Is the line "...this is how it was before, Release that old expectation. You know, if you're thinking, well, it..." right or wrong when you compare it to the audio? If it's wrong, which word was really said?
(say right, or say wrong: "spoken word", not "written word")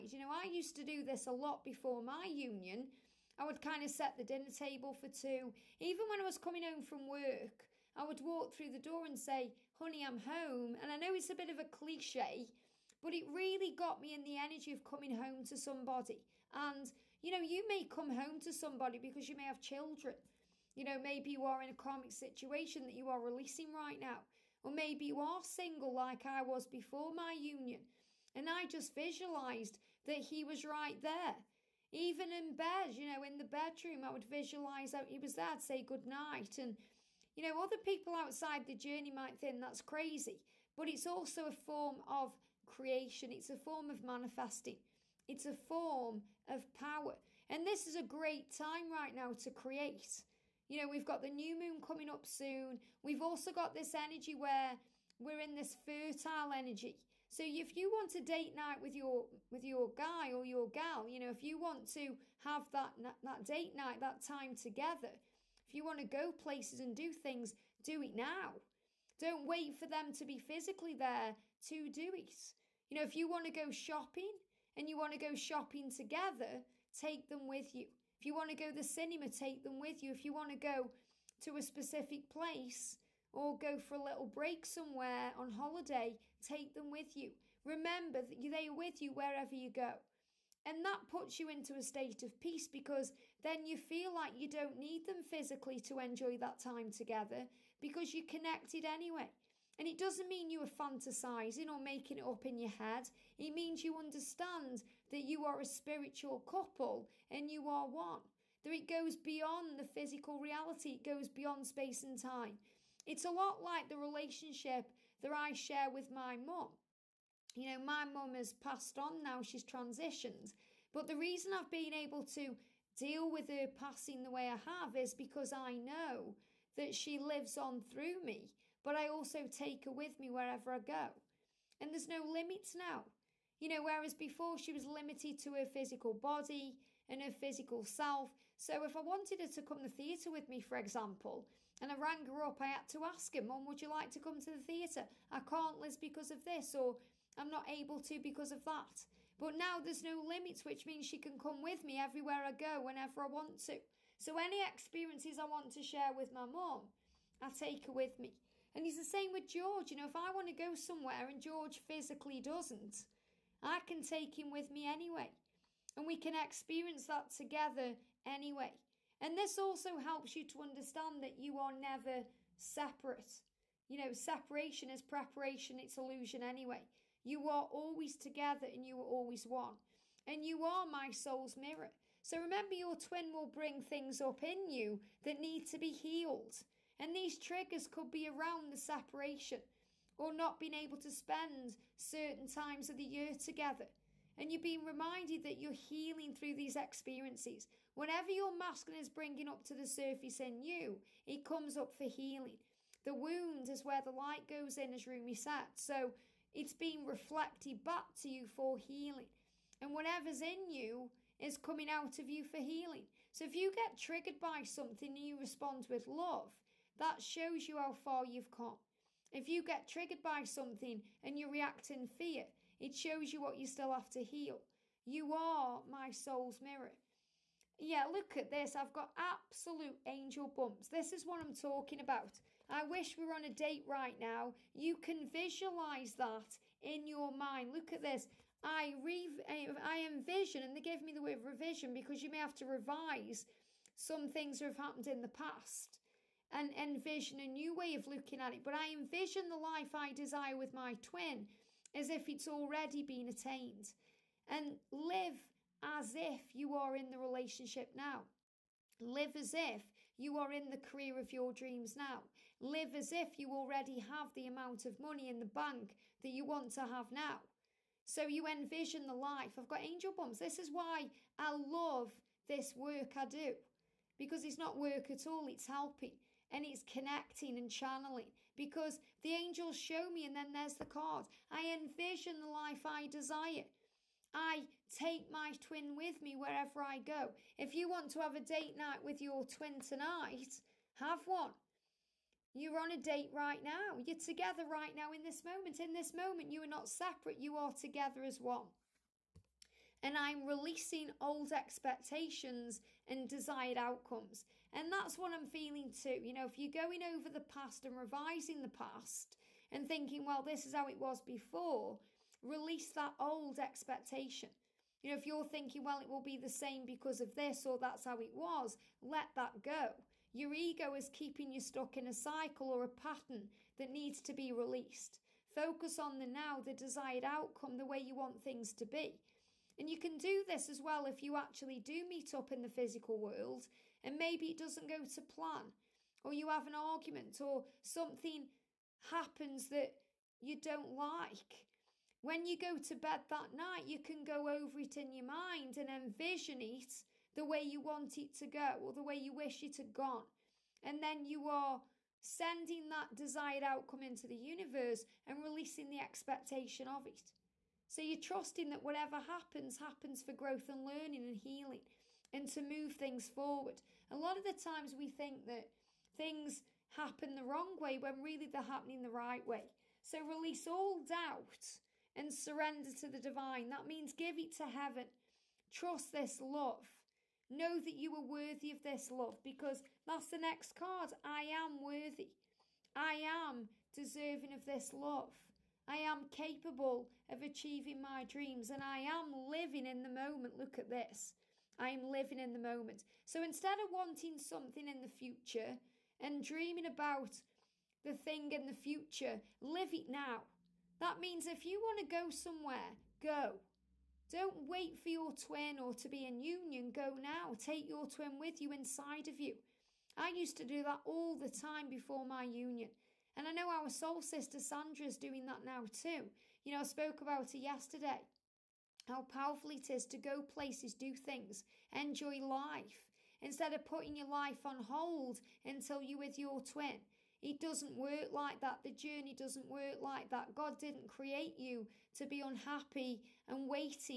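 right.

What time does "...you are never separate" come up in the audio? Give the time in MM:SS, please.
02:51.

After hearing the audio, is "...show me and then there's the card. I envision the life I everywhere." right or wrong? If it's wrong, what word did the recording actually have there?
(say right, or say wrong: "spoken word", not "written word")
wrong: "desire", not "everywhere".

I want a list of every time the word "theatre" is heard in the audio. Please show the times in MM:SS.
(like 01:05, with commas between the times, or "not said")
02:19, 02:24.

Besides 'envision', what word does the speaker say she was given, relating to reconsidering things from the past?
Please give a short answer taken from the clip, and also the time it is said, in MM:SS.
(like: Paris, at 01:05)
revision, at 04:01.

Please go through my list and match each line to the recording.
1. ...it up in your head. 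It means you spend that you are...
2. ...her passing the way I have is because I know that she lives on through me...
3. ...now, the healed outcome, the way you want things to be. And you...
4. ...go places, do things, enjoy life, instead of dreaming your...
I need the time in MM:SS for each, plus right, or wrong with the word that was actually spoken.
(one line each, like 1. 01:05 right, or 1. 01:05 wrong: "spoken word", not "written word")
1. 01:42 wrong: "understand", not "spend"
2. 02:03 right
3. 05:26 wrong: "desired", not "healed"
4. 07:00 wrong: "putting", not "dreaming".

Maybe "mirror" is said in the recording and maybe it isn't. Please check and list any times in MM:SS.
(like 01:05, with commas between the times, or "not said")
03:01, 03:46.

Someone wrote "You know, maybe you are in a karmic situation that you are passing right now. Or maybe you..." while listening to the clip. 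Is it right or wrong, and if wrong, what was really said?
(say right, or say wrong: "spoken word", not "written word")
wrong: "releasing", not "passing".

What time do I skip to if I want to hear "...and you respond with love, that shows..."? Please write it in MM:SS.
03:35.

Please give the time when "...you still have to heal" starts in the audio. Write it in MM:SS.
03:43.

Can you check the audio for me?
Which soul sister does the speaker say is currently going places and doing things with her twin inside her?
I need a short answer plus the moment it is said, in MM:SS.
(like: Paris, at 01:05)
Sandra, at 06:54.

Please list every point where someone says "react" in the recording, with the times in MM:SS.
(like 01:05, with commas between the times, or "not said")
03:41.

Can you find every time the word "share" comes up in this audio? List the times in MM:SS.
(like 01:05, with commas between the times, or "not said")
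01:55, 02:35.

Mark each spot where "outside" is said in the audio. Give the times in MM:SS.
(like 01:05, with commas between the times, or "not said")
00:38.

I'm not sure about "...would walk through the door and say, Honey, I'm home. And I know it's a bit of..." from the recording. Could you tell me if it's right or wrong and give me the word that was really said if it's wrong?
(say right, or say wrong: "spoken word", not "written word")
right.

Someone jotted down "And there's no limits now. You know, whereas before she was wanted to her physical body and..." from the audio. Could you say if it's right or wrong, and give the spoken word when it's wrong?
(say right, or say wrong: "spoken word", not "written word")
wrong: "limited", not "wanted".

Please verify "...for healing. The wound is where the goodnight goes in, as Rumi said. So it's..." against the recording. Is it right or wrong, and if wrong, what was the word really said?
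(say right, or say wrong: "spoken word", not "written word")
wrong: "light", not "goodnight".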